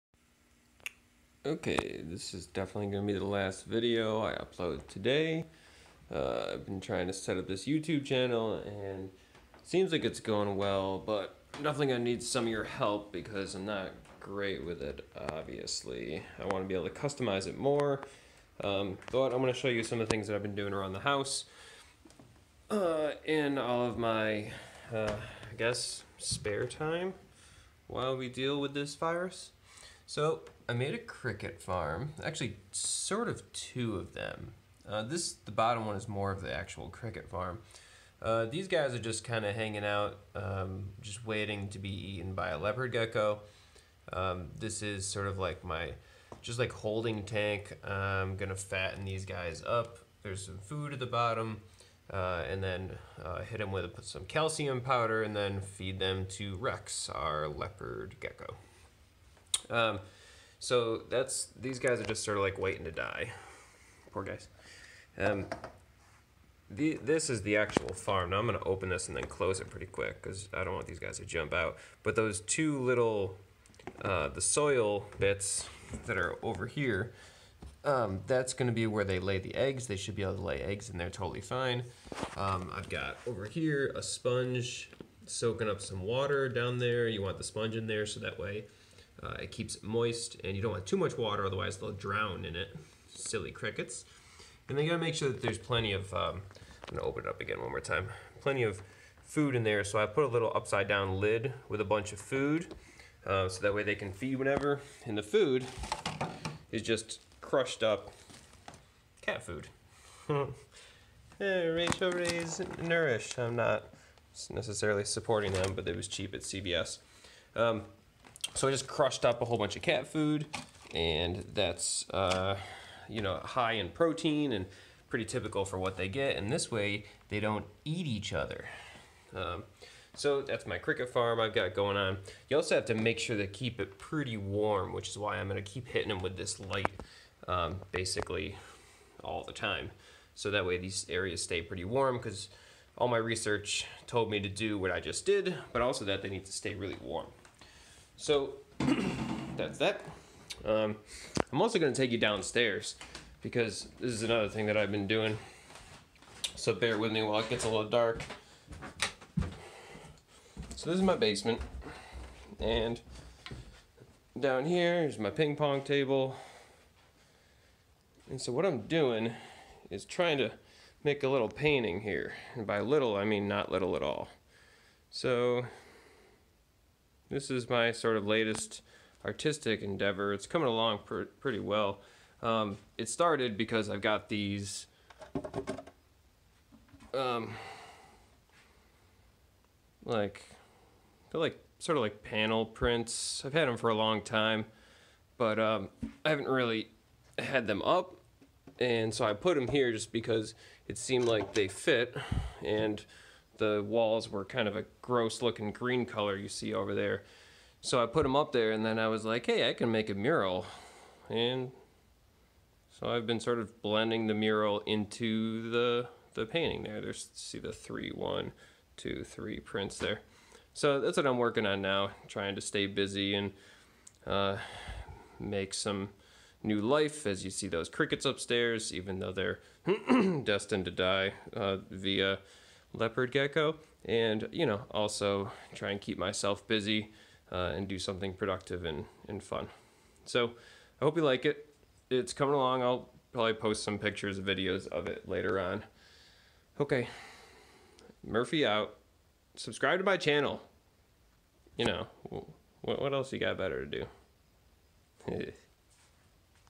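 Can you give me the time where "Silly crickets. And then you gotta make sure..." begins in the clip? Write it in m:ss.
1:33.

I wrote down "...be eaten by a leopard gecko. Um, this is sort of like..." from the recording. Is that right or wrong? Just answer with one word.
right.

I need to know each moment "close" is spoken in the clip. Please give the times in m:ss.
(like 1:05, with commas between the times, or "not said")
1:09.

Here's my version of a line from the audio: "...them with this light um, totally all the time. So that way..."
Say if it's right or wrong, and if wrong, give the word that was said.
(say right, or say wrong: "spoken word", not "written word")
wrong: "basically", not "totally".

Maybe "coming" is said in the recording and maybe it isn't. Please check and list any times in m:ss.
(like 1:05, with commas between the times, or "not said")
3:00, 4:02.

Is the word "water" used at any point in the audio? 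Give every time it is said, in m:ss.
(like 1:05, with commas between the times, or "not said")
1:26, 1:31.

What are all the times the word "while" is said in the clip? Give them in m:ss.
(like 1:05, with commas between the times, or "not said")
0:27, 2:37.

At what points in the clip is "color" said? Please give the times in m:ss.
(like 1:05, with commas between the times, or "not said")
3:26.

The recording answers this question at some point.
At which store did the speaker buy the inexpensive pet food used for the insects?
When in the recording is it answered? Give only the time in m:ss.
1:56.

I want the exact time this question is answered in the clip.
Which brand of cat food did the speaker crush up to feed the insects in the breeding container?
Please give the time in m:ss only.
1:51.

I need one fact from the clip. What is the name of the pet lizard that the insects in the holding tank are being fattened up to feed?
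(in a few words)
Rex.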